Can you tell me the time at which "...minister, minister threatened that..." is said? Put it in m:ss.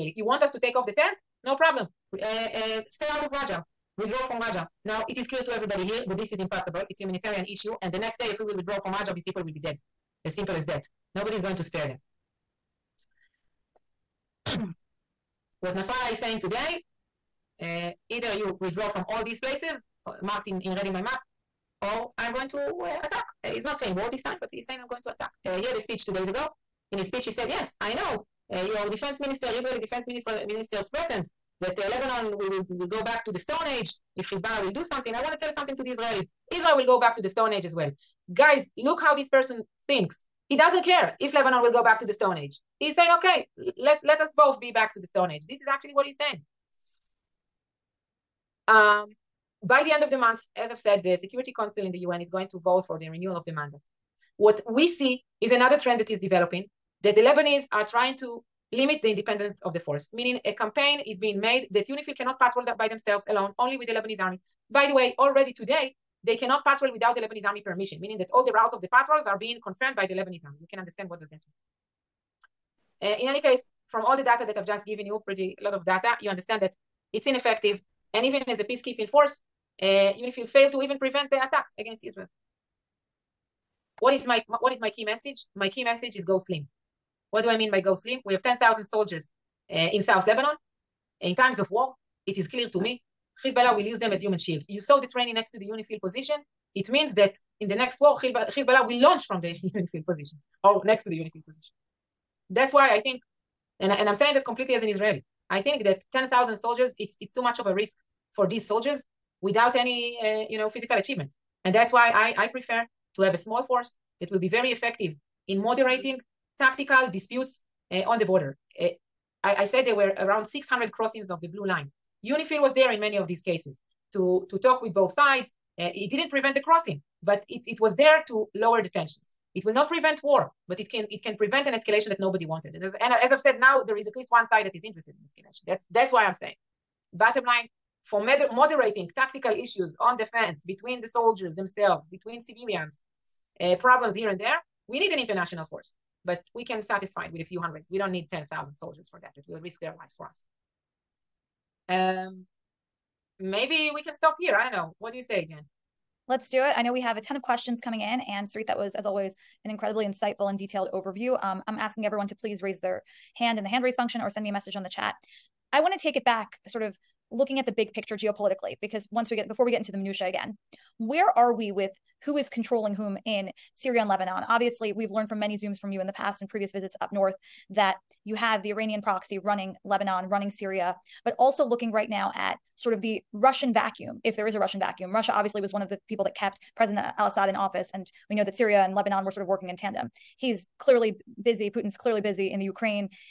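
0:30.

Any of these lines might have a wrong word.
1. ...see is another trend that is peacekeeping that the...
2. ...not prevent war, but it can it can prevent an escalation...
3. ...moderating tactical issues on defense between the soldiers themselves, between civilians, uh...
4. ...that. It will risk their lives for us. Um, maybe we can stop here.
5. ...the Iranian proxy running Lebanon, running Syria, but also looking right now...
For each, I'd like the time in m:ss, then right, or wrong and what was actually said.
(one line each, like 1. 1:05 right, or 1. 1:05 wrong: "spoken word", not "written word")
1. 0:54 wrong: "developing", not "peacekeeping"
2. 2:09 right
3. 2:18 right
4. 2:29 right
5. 2:58 right.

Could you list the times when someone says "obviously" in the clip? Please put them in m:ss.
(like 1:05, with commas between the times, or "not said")
2:54, 3:05.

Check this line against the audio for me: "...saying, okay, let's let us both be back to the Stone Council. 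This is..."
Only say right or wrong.
wrong.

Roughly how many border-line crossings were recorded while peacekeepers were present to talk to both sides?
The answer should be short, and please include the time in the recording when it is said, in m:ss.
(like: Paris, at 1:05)
600, at 2:00.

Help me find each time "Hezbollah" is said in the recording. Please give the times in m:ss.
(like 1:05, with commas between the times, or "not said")
0:34, 1:33, 1:38.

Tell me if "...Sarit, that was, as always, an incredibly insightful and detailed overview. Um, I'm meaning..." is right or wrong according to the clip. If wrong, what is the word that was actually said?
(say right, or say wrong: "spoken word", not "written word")
wrong: "asking", not "meaning".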